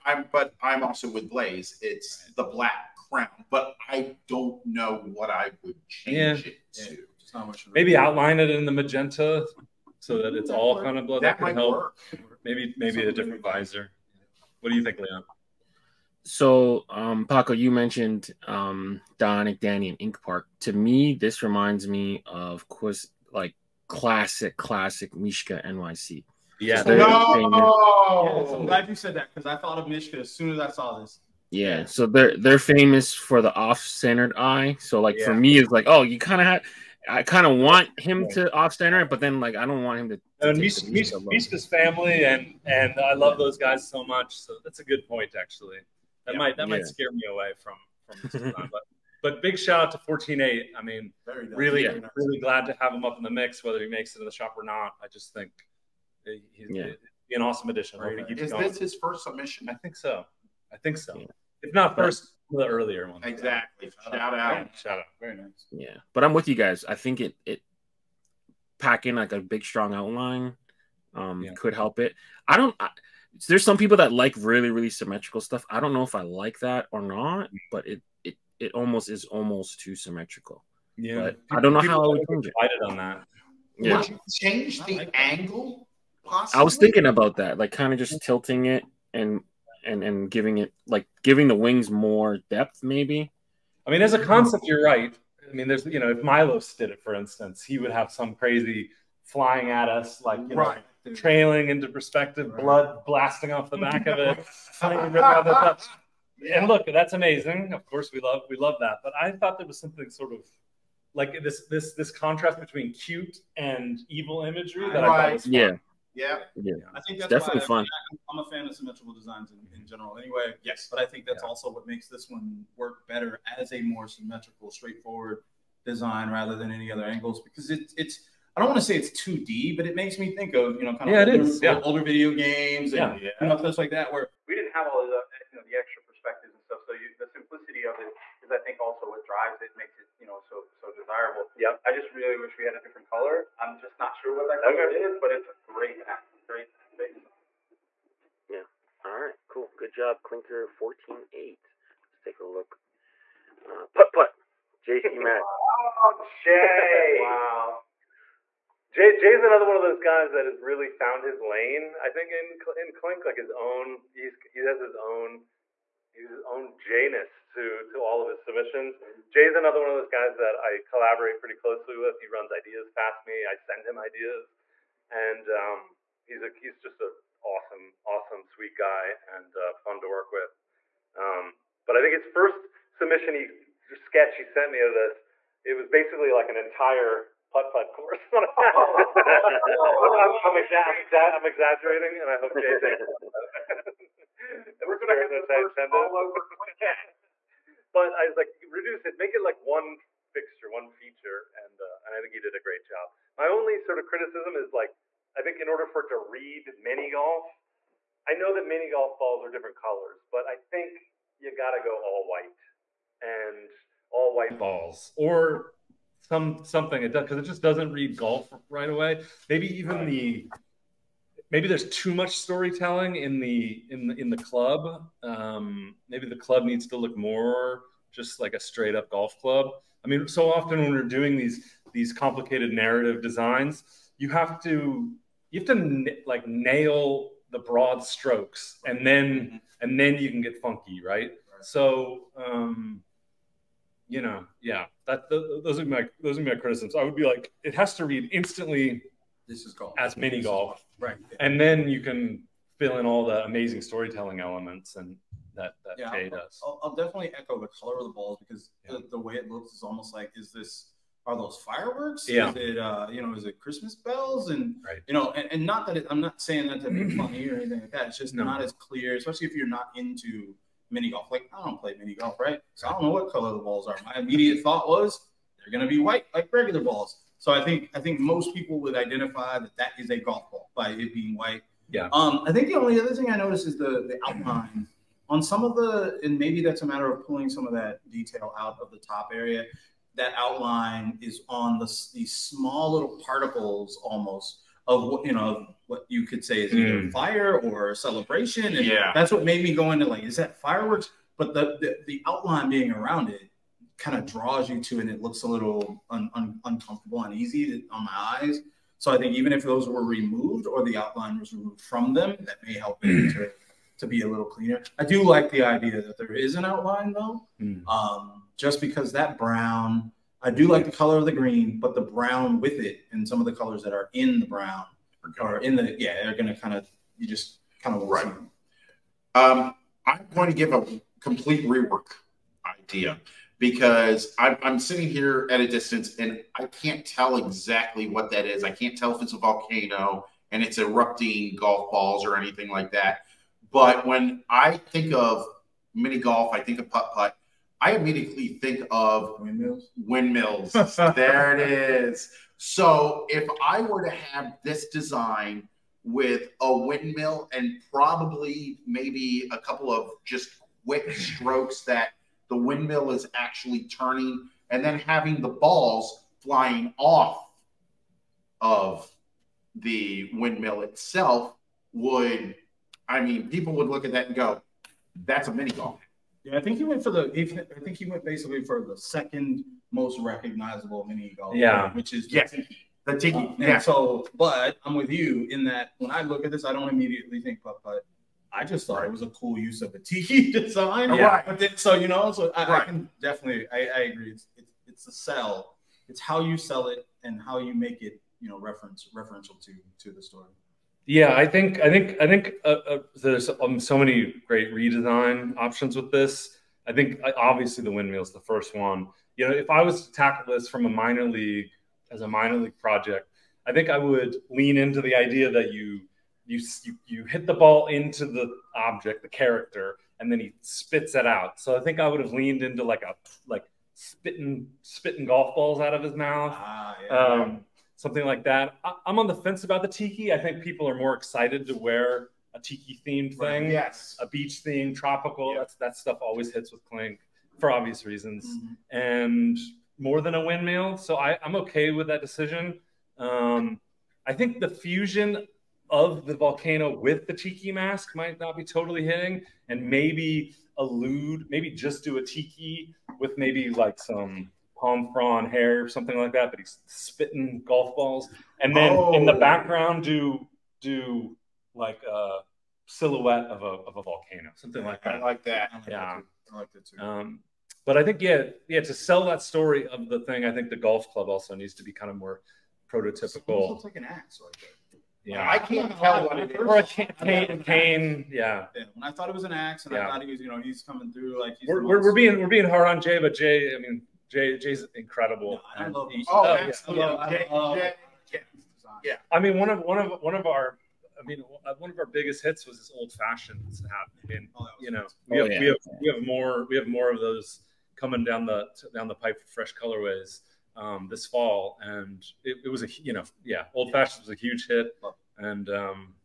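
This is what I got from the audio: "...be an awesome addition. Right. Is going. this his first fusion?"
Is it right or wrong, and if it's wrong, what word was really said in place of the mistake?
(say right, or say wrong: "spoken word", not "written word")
wrong: "submission", not "fusion".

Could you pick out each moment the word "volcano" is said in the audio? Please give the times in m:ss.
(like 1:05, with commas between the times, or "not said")
5:39, 7:26, 7:44.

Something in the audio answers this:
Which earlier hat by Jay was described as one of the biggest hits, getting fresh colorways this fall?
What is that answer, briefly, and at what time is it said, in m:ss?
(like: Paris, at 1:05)
old fashioned hat, at 8:12.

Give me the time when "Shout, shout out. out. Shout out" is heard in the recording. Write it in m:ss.
1:04.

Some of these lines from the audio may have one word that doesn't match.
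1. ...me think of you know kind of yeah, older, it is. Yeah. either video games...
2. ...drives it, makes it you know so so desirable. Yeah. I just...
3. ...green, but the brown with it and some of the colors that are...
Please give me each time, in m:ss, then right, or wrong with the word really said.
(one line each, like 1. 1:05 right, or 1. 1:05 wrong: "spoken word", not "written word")
1. 2:10 wrong: "older", not "either"
2. 2:19 right
3. 5:21 right.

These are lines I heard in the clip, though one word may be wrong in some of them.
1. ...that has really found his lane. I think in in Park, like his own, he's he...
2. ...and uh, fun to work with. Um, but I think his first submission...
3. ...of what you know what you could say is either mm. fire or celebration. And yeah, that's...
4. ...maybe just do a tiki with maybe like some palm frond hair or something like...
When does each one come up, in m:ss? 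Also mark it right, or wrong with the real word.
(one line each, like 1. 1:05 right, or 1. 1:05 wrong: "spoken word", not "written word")
1. 2:40 wrong: "Clink", not "Park"
2. 2:59 right
3. 4:54 right
4. 7:31 right.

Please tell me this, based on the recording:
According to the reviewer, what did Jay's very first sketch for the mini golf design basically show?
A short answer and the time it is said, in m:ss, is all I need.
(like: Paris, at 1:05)
an entire putt putt course, at 3:06.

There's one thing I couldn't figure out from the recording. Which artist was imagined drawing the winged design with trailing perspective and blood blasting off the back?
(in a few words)
Milos.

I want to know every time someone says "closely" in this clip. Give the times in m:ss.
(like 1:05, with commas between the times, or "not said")
2:51.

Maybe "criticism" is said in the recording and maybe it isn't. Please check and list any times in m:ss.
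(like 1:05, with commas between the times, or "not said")
3:24, 4:06.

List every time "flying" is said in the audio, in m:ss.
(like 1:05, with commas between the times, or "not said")
1:39, 6:06.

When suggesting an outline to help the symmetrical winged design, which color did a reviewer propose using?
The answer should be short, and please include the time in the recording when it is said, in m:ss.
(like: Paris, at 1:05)
magenta, at 0:08.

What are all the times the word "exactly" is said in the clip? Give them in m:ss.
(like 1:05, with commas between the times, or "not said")
1:03, 5:37.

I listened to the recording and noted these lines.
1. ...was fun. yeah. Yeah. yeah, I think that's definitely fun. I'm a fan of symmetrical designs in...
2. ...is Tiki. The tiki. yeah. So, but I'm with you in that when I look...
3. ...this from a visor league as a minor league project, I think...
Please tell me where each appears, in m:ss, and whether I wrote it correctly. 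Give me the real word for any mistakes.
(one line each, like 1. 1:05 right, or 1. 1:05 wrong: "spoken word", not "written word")
1. 1:55 right
2. 6:22 right
3. 6:50 wrong: "minor", not "visor".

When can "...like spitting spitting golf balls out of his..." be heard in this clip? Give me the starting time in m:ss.
7:03.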